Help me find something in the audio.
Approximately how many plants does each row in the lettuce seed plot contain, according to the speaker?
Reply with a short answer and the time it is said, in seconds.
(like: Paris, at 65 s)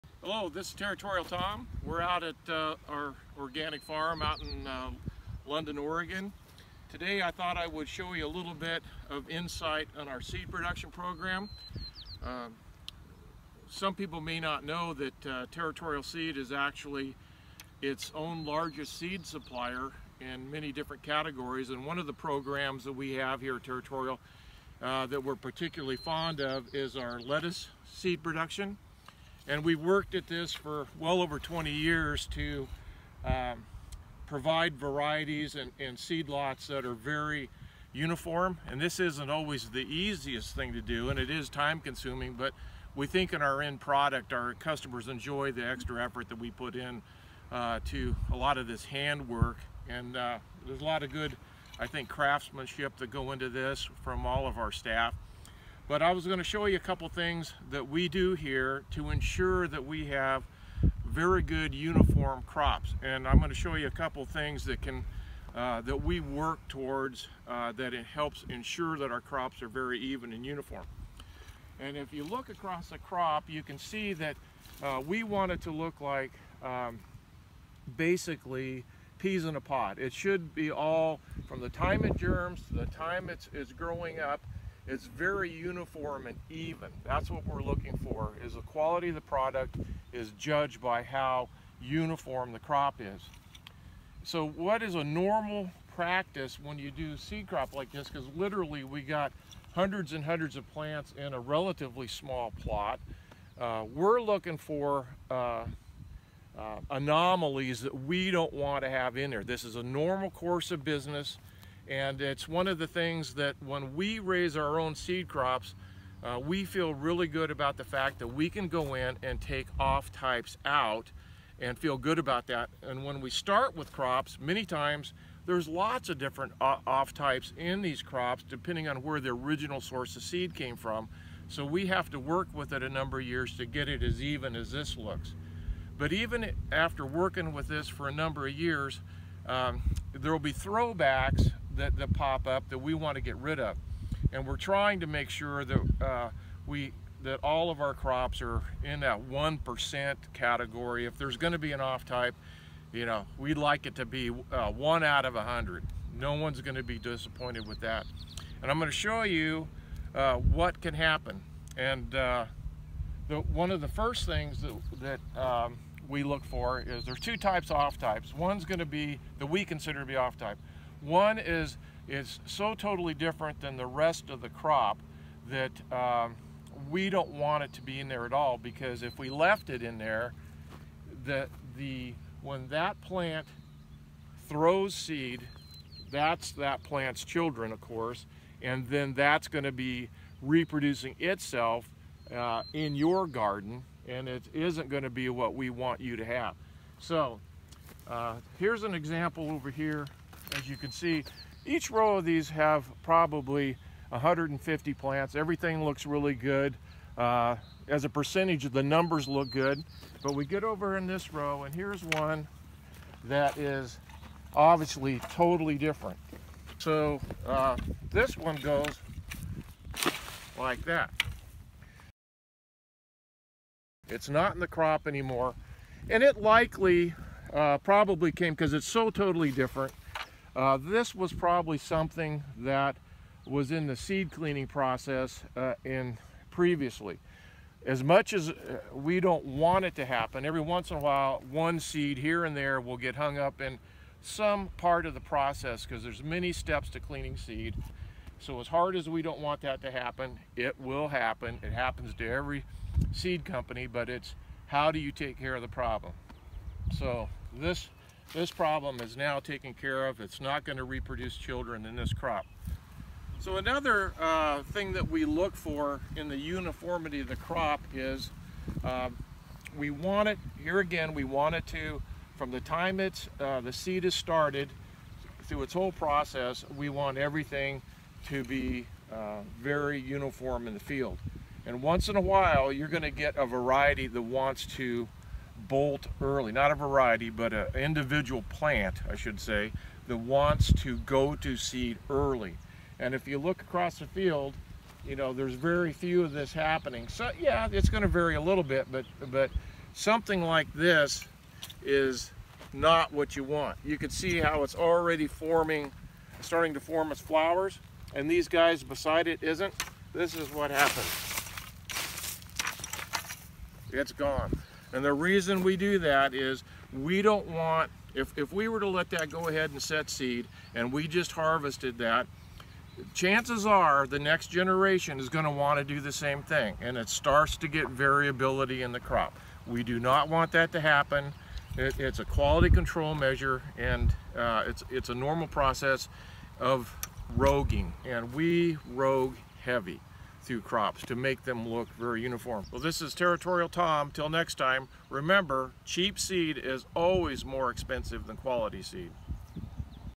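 150, at 204 s.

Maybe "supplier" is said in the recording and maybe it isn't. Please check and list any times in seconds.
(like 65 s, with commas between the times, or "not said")
19 s.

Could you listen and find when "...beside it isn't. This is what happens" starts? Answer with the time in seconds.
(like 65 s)
308 s.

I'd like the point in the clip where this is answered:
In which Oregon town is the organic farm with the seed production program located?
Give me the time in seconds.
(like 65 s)
5 s.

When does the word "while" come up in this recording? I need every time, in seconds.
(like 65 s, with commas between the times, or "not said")
240 s, 282 s.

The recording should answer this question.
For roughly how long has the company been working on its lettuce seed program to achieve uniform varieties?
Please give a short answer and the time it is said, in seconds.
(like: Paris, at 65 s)
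over 20 years, at 30 s.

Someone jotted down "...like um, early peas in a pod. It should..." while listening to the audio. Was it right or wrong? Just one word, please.
wrong.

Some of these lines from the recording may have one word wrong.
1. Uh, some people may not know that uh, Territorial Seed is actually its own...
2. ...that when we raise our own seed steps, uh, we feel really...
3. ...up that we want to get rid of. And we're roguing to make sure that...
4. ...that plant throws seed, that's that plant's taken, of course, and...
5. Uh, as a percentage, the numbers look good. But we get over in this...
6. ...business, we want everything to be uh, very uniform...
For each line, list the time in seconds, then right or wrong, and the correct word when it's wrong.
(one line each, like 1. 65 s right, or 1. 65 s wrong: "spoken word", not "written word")
1. 12 s right
2. 113 s wrong: "crops", not "steps"
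3. 142 s wrong: "trying", not "roguing"
4. 182 s wrong: "children", not "taken"
5. 207 s right
6. 275 s wrong: "process", not "business".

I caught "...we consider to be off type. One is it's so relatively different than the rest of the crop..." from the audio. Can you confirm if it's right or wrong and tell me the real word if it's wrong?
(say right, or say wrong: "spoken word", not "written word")
wrong: "totally", not "relatively".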